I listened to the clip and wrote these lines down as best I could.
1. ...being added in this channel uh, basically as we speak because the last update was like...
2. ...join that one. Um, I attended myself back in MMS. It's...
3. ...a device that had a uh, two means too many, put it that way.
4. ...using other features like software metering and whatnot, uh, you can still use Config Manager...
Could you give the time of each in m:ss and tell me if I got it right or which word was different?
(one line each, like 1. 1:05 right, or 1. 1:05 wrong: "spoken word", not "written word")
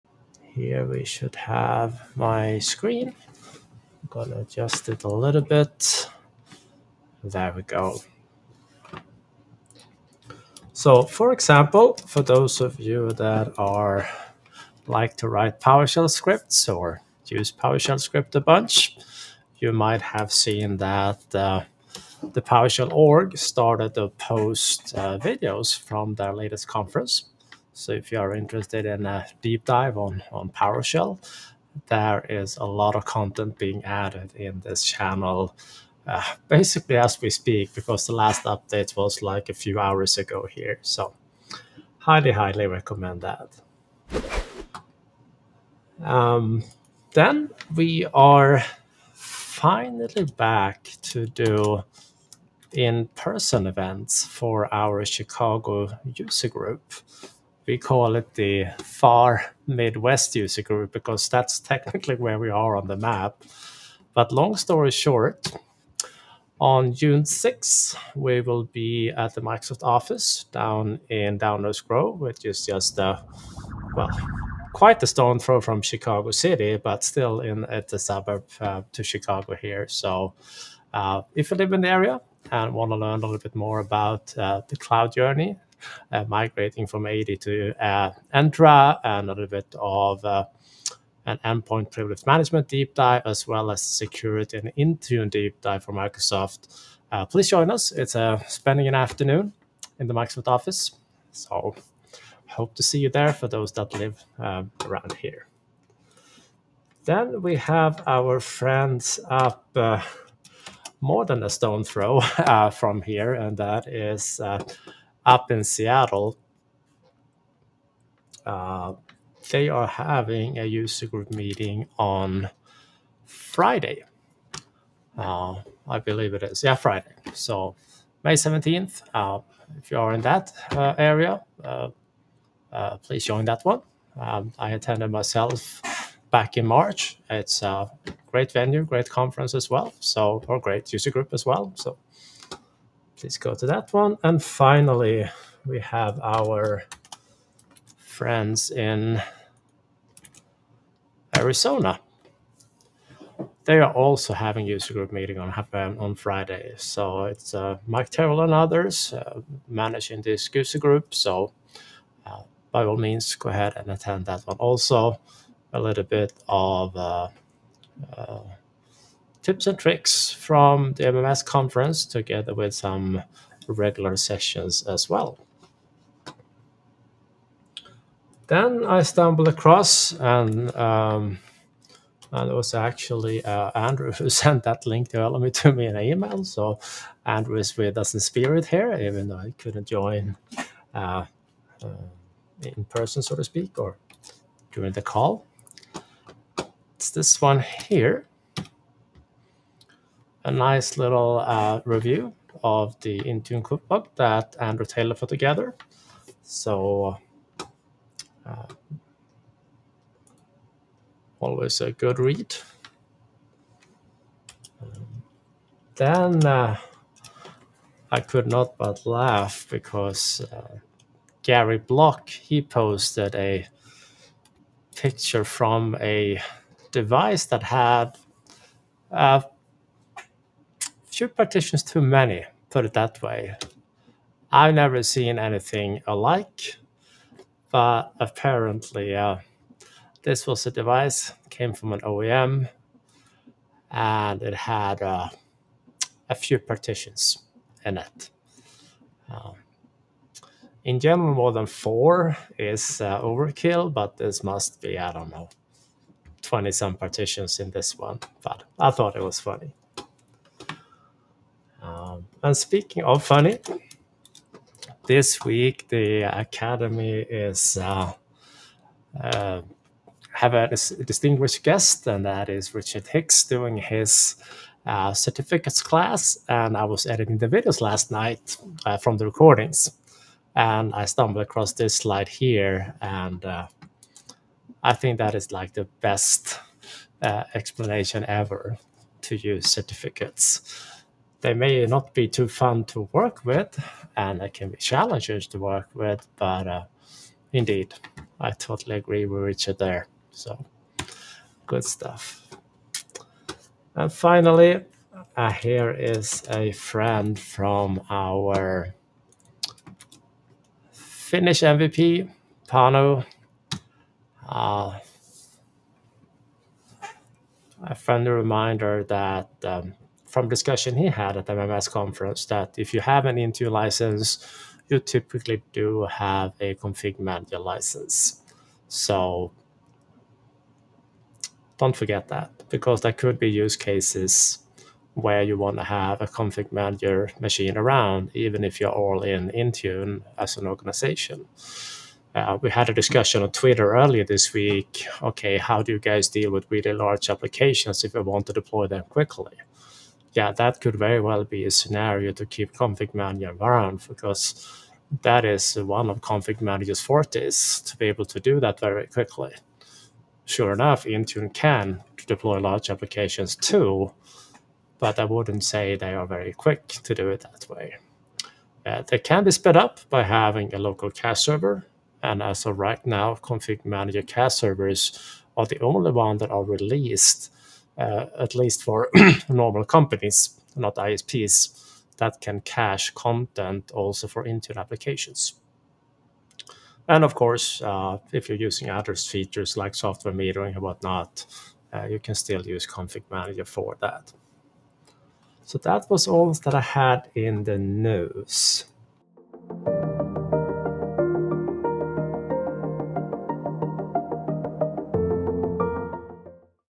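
1. 0:33 right
2. 2:13 wrong: "March", not "MMS"
3. 3:46 wrong: "partitions", not "means"
4. 6:28 right.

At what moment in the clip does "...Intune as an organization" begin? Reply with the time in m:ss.
5:39.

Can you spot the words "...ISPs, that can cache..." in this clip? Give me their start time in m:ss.
6:20.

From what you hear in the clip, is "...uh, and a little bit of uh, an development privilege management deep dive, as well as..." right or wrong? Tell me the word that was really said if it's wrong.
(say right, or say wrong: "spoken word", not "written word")
wrong: "endpoint", not "development".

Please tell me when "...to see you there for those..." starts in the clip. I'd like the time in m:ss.
1:42.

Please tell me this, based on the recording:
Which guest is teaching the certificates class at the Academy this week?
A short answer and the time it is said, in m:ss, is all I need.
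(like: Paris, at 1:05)
Richard Hicks, at 4:32.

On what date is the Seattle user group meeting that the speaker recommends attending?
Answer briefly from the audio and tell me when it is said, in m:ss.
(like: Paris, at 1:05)
May 17th, at 2:08.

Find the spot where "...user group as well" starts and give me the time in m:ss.
2:20.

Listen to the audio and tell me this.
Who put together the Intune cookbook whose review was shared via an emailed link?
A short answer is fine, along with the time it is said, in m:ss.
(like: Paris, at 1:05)
Andrew Taylor, at 3:24.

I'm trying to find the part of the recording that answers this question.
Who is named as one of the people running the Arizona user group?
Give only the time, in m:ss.
2:37.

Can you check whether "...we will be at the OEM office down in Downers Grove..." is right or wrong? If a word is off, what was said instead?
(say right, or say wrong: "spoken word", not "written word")
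wrong: "Microsoft", not "OEM".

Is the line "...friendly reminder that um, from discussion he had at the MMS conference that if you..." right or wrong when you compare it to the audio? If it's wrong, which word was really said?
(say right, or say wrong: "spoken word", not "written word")
right.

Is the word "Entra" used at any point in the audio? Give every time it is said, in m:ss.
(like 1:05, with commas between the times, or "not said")
1:28.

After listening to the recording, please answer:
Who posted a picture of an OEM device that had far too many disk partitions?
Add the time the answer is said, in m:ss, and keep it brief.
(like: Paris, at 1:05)
Gary Blok, at 3:41.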